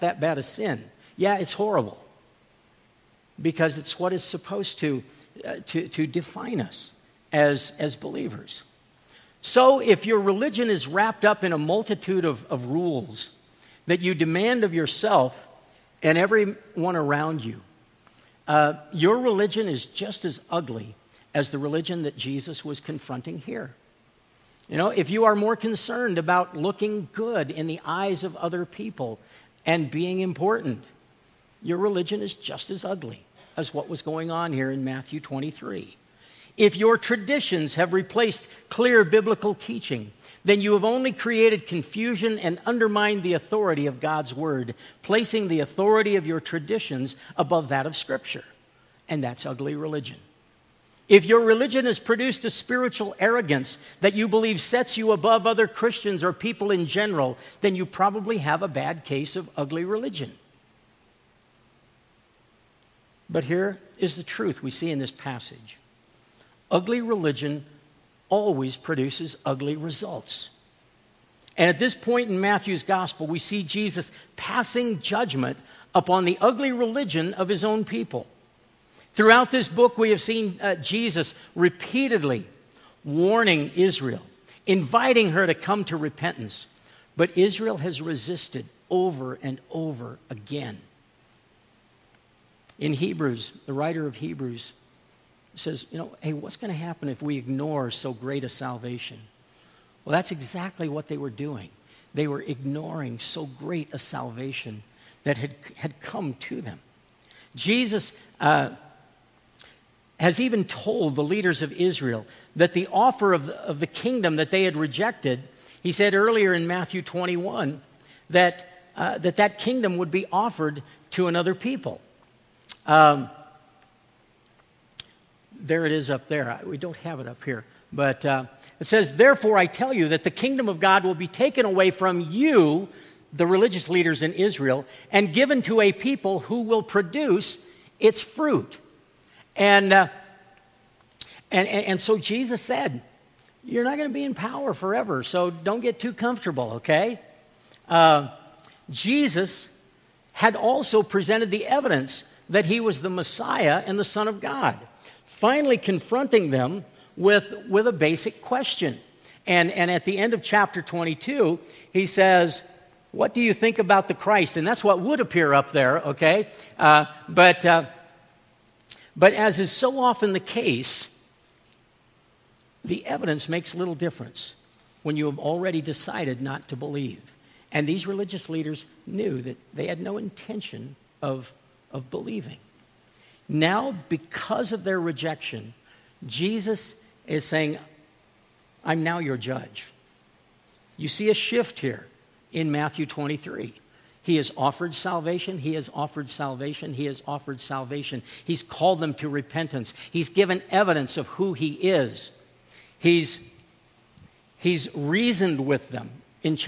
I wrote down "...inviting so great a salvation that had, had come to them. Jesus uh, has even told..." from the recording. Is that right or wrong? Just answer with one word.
wrong.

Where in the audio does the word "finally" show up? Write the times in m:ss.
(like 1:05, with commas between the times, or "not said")
2:35.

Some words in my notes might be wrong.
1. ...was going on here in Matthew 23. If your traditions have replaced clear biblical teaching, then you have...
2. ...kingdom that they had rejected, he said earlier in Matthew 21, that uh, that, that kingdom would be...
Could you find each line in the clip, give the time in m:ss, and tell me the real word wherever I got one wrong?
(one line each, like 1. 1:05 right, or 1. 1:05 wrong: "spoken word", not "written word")
1. 0:33 right
2. 1:53 right.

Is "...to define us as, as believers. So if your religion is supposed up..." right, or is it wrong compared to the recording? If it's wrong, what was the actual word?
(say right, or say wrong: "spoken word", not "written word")
wrong: "wrapped", not "supposed".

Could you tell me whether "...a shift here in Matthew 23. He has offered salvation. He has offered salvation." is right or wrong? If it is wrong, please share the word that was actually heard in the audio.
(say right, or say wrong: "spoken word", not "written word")
right.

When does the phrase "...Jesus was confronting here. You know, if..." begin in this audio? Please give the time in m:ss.
0:22.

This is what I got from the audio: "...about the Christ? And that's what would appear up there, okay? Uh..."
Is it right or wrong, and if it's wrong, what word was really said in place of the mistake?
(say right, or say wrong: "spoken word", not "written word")
right.